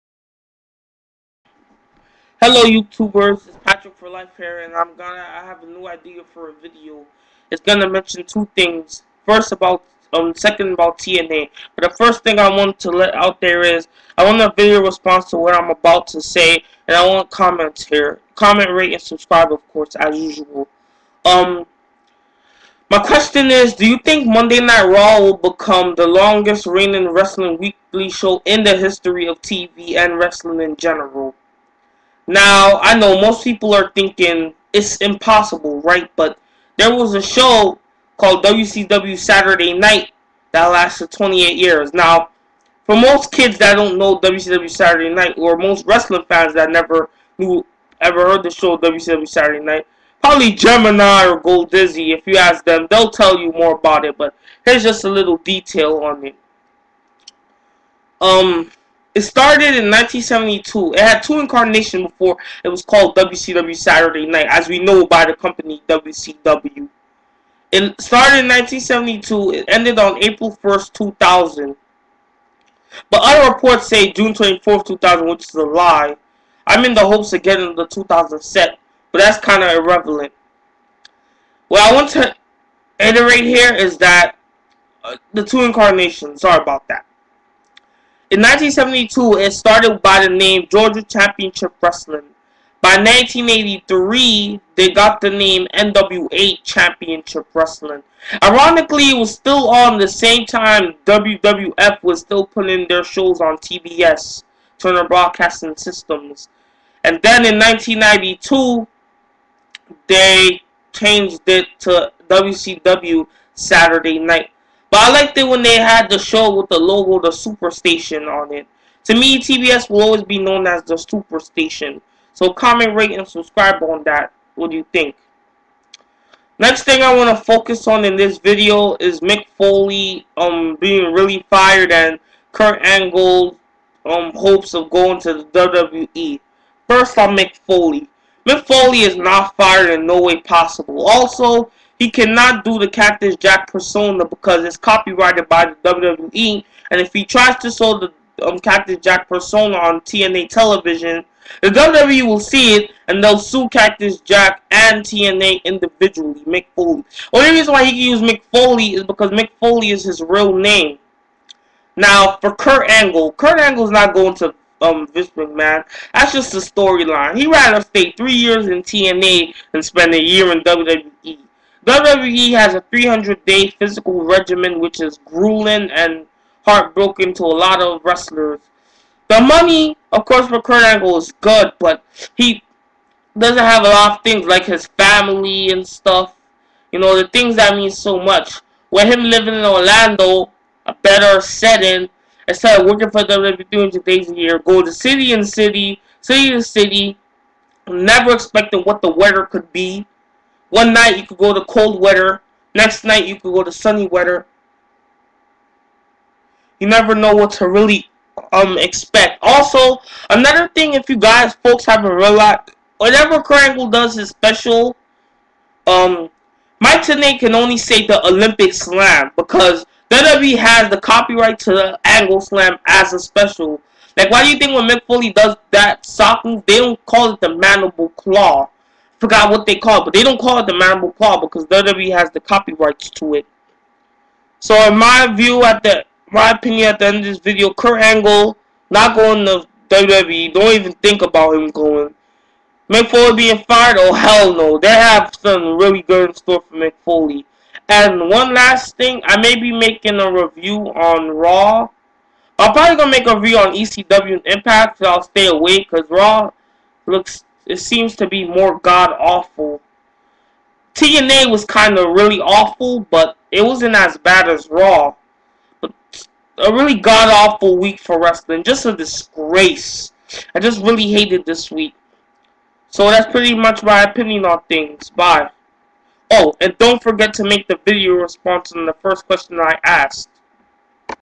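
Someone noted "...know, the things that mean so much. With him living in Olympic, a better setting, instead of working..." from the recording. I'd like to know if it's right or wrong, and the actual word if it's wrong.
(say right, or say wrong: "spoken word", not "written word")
wrong: "Orlando", not "Olympic".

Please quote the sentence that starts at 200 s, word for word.
One night you could go to cold weather.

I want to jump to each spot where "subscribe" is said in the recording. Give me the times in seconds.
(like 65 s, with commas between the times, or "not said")
19 s, 123 s.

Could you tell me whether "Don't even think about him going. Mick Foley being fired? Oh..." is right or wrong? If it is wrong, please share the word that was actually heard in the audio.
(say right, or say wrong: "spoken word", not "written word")
right.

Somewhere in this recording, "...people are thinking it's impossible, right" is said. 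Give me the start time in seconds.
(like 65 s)
33 s.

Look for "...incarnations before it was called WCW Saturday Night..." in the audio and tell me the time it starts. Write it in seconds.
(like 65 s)
61 s.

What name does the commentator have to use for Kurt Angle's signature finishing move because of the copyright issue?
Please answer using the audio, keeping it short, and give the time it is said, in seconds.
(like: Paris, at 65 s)
the Olympic Slam, at 218 s.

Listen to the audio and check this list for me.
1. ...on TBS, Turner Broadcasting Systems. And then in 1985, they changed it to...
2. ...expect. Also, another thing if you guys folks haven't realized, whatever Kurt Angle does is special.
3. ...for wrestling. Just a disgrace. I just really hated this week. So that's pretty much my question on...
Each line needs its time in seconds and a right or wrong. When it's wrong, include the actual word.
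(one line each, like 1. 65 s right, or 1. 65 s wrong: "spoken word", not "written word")
1. 103 s wrong: "1992", not "1985"
2. 208 s right
3. 267 s wrong: "opinion", not "question".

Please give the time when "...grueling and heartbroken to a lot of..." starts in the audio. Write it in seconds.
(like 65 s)
175 s.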